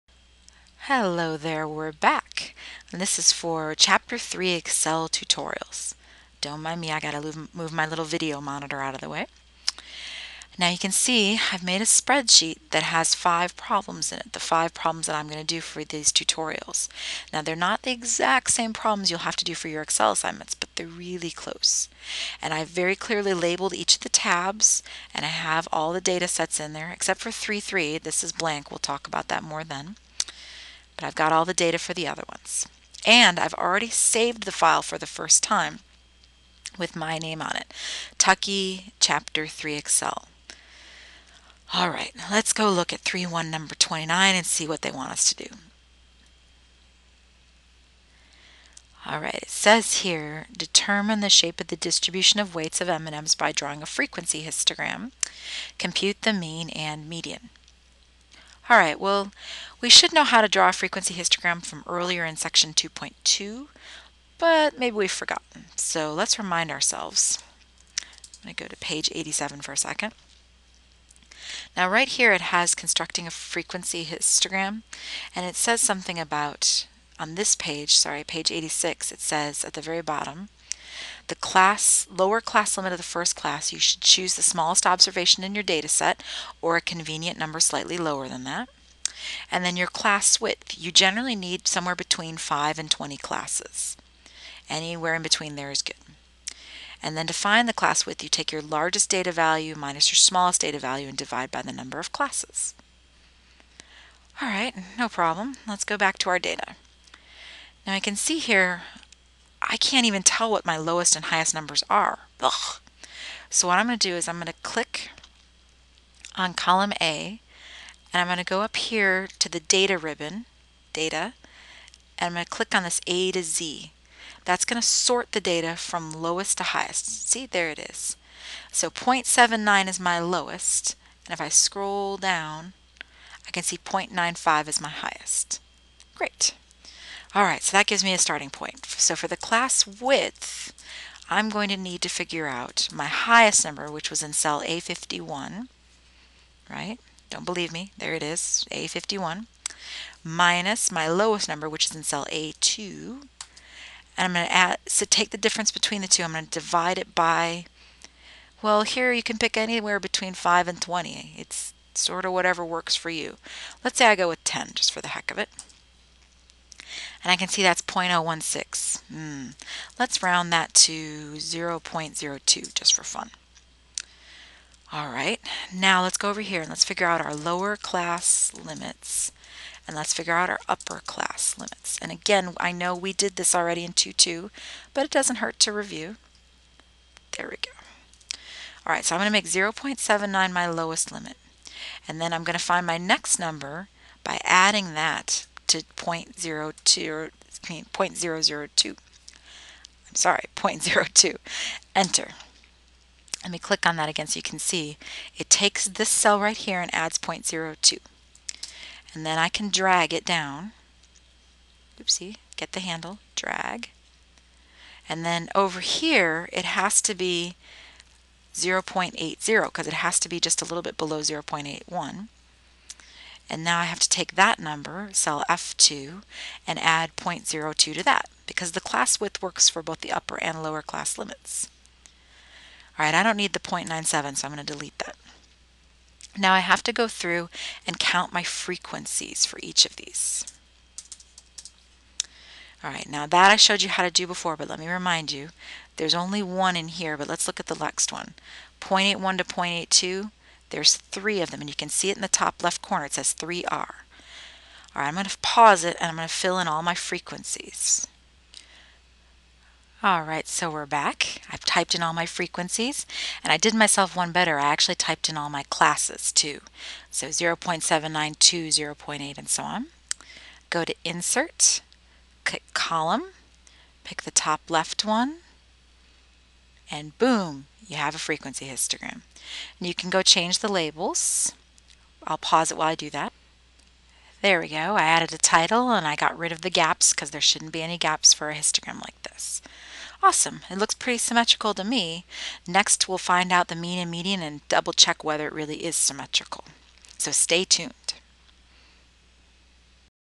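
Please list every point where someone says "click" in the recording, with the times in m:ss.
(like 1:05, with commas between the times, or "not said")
1:54, 2:02, 3:23, 4:32.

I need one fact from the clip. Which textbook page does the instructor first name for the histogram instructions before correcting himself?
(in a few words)
87.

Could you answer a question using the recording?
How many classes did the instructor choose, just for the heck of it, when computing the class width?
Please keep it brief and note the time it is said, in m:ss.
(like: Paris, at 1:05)
10, at 2:44.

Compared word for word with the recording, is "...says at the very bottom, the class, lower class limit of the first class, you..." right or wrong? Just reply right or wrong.
right.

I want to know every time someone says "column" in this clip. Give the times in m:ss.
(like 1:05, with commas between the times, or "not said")
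1:56, 4:32.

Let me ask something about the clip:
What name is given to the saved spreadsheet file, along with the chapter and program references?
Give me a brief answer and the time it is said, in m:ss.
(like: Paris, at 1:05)
Tuckey, at 0:38.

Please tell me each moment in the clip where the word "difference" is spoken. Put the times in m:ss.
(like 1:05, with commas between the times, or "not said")
2:35.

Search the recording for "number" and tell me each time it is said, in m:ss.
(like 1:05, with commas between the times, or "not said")
0:43, 1:27, 1:41, 1:51, 2:23, 2:31, 3:13, 3:44.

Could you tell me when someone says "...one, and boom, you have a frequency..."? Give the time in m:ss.
4:35.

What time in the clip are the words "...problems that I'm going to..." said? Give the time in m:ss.
0:14.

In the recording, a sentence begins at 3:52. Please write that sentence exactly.
All right, I don't need the 0.97, so I'm going to delete that.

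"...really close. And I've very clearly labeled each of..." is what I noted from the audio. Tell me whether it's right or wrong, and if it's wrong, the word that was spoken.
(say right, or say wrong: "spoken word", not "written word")
right.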